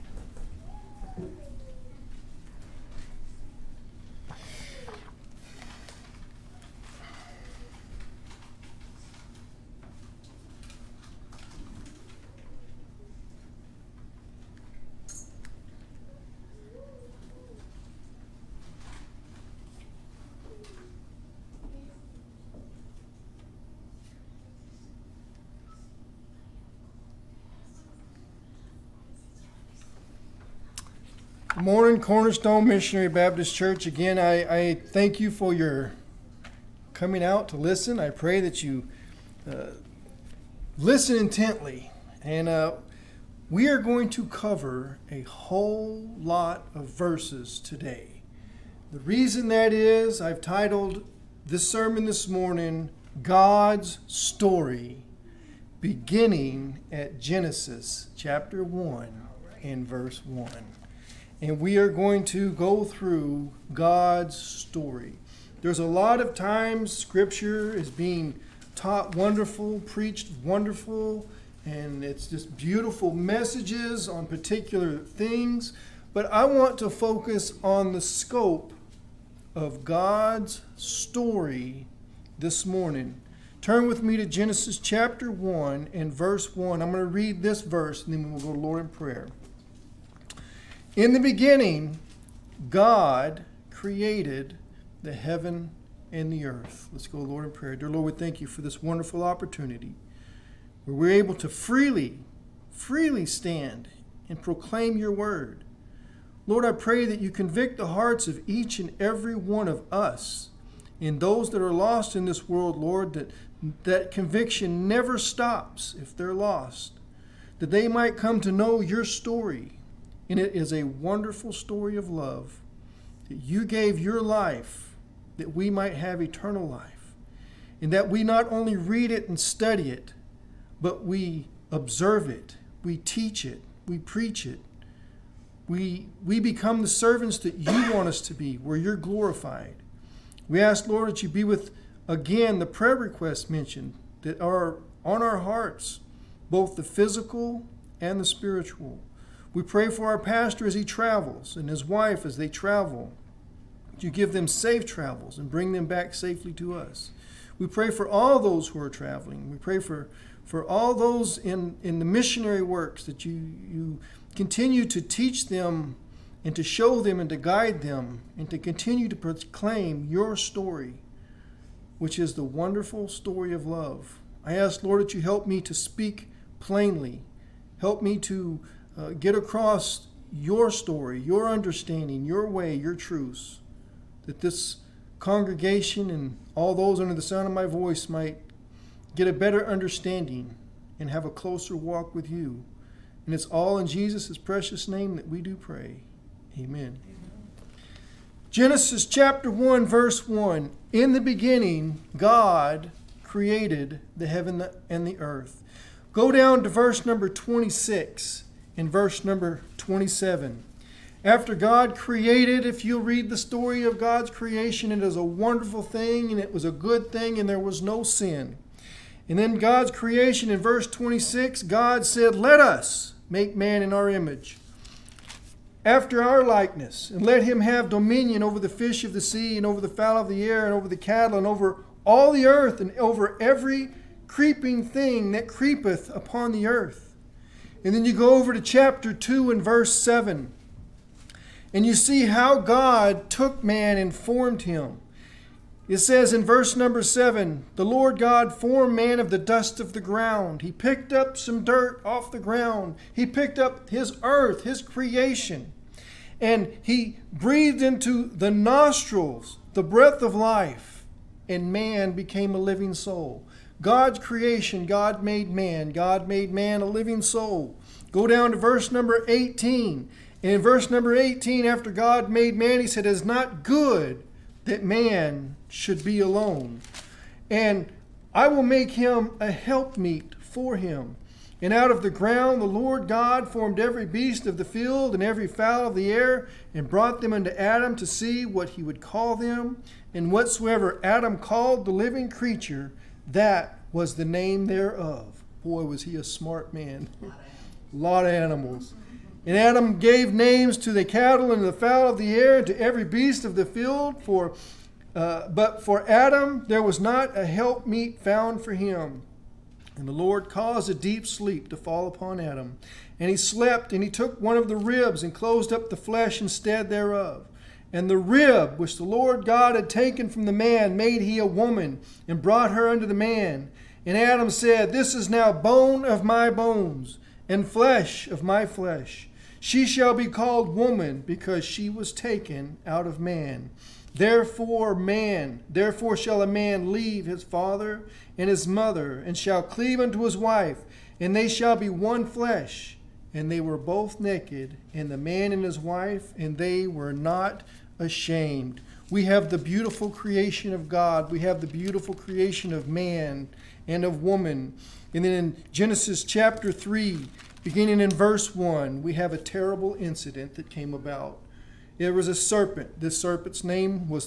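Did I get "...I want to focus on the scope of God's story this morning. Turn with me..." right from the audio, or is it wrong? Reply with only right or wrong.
right.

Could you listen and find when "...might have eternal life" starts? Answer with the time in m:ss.
2:05.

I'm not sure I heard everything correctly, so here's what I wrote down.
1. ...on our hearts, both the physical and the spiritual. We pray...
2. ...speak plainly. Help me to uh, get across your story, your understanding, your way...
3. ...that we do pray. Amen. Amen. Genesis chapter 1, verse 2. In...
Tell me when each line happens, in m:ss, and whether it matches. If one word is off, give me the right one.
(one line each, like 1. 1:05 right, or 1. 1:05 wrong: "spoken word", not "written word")
1. 2:25 right
2. 2:55 right
3. 3:15 wrong: "1", not "2".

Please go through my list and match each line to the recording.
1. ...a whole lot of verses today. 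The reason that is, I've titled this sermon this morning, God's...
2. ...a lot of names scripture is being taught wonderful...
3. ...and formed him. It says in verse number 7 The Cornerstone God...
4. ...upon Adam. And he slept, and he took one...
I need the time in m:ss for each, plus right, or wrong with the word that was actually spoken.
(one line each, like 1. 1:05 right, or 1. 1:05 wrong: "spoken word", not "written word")
1. 0:45 right
2. 1:05 wrong: "times", not "names"
3. 4:03 wrong: "Lord", not "Cornerstone"
4. 5:12 right.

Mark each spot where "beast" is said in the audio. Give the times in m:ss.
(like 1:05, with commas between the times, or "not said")
4:44, 5:03.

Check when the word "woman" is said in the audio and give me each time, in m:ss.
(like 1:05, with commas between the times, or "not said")
5:21, 5:30, 5:54.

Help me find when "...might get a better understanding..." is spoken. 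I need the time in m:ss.
3:08.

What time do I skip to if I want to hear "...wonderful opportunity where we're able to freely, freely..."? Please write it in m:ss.
1:38.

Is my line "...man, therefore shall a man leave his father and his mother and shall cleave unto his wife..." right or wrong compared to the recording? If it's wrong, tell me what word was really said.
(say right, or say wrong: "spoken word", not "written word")
right.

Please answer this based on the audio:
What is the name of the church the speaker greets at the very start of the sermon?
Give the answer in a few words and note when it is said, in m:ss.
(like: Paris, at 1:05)
Cornerstone Missionary Baptist Church, at 0:31.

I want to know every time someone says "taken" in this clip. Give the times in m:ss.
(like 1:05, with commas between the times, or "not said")
5:19, 5:32.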